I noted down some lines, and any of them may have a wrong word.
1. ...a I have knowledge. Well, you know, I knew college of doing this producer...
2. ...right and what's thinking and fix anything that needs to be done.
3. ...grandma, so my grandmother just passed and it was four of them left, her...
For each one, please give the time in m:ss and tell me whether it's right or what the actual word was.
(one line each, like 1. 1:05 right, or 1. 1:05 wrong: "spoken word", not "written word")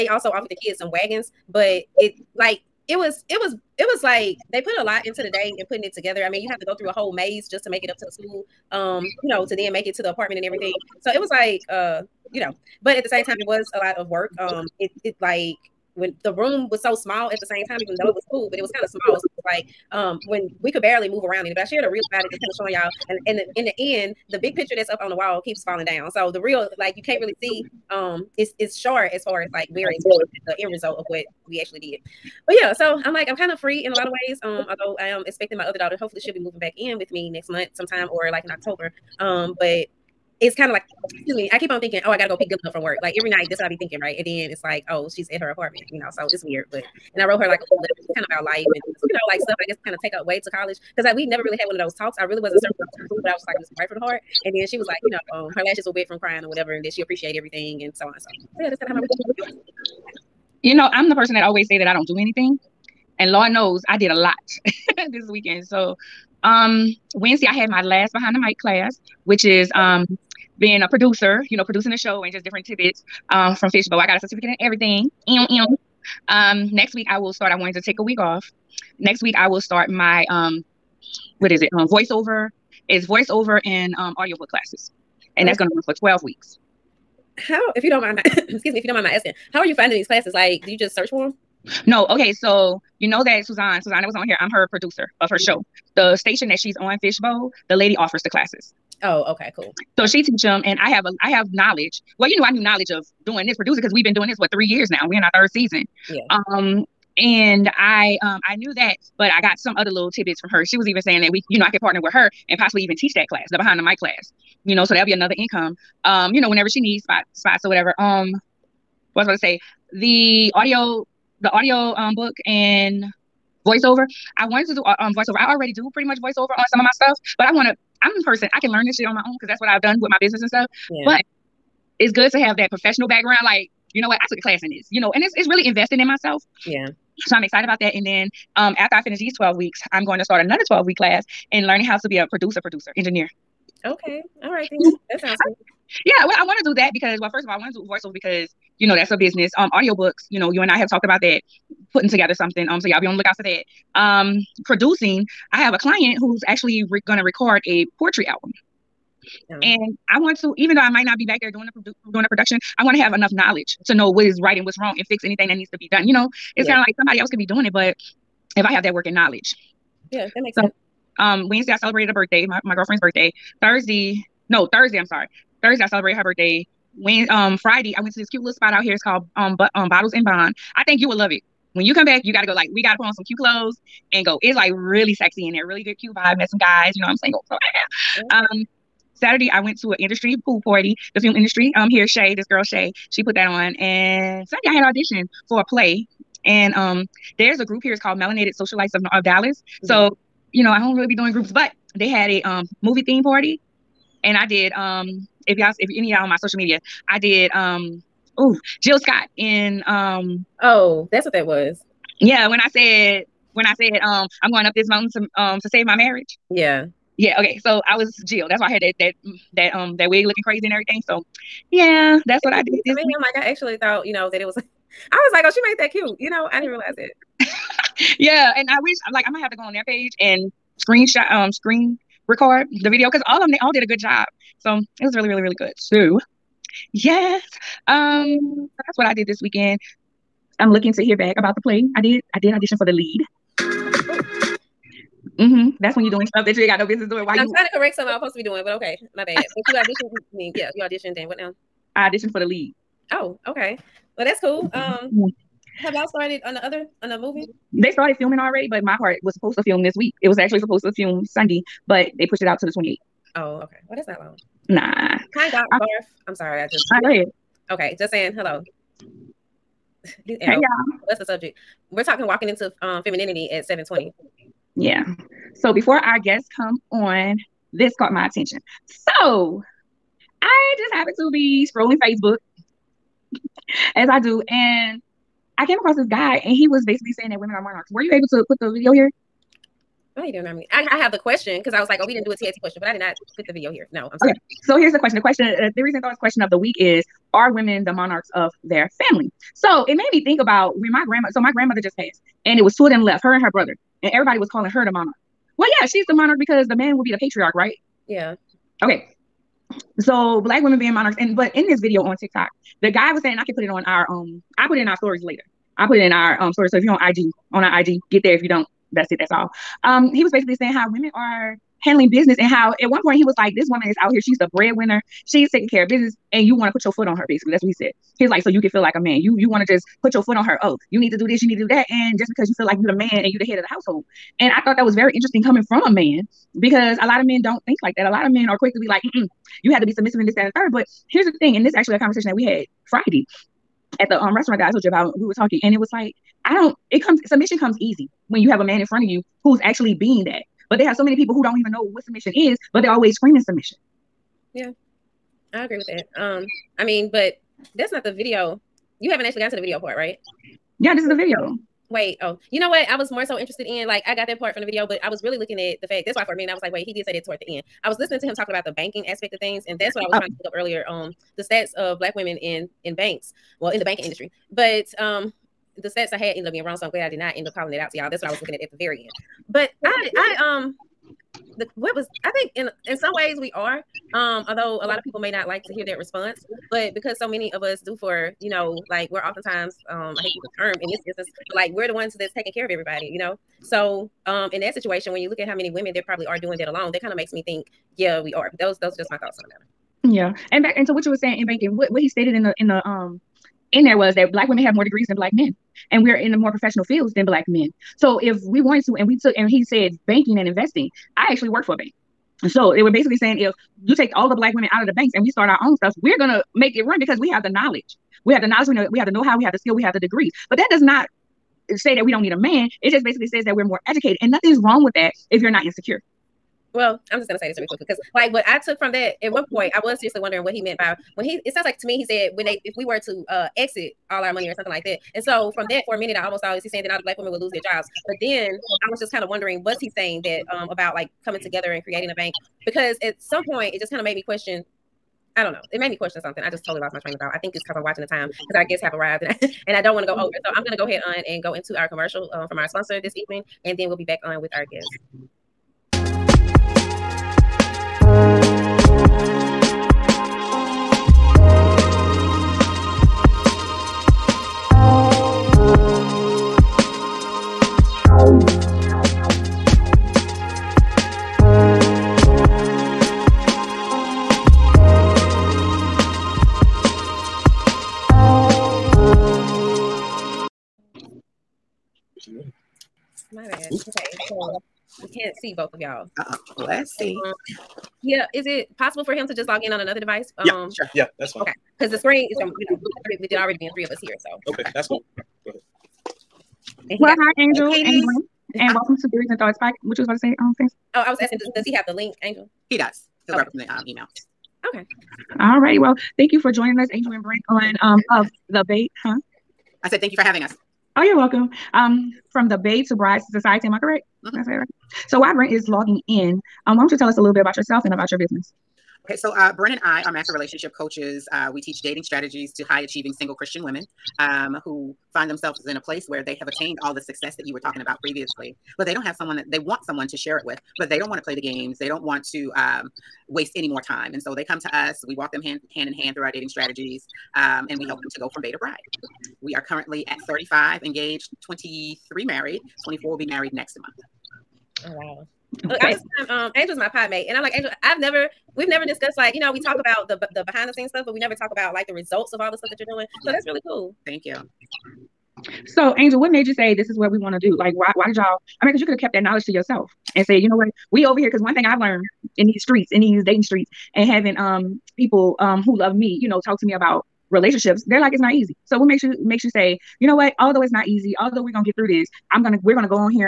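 1. 1:41 wrong: "knowledge", not "college"
2. 2:44 wrong: "wrong", not "thinking"
3. 5:01 wrong: "two", not "four".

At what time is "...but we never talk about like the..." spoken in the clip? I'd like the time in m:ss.
9:11.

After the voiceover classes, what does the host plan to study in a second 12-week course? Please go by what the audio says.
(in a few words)
Producer engineer.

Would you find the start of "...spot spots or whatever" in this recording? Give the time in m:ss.
1:57.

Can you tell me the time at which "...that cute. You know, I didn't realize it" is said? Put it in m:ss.
3:45.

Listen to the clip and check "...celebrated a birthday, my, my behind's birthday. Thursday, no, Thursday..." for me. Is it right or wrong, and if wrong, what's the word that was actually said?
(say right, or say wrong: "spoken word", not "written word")
wrong: "girlfriend", not "behind".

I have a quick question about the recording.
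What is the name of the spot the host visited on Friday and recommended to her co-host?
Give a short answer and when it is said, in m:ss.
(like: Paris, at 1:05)
Bottles and Bond, at 2:59.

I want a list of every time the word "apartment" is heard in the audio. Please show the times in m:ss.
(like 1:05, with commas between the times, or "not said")
0:10, 0:45.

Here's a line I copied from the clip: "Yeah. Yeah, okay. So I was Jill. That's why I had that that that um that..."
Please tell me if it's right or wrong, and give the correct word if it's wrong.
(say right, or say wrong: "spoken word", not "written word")
right.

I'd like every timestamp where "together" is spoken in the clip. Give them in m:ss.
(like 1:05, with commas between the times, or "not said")
0:05, 2:32, 7:21.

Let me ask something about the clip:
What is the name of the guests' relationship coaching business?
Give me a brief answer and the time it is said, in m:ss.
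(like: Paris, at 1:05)
Bae to Bride Society, at 8:32.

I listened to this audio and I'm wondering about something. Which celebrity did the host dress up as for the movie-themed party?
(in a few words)
Jill Scott.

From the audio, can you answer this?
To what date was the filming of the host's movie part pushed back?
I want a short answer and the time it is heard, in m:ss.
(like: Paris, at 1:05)
28th, at 4:22.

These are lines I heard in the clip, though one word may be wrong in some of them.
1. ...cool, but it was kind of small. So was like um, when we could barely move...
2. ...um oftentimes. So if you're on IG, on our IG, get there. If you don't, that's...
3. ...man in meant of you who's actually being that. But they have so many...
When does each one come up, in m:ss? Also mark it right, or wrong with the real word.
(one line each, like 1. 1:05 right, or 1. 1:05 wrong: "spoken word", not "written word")
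1. 0:18 right
2. 5:16 wrong: "stories", not "oftentimes"
3. 5:48 wrong: "front", not "meant".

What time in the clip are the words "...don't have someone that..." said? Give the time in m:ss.
8:48.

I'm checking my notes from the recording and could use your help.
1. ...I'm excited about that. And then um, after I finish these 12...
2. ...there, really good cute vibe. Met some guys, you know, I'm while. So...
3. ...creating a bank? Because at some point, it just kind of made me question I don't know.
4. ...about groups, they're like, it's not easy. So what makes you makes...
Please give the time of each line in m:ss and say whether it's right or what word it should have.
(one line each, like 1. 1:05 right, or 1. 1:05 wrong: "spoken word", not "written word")
1. 2:17 right
2. 3:05 wrong: "single", not "while"
3. 7:21 right
4. 9:26 wrong: "relationships", not "groups".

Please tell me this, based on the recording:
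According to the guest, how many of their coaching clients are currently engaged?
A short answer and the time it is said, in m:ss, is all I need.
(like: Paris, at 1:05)
35, at 9:00.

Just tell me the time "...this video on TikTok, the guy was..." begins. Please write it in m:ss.
5:11.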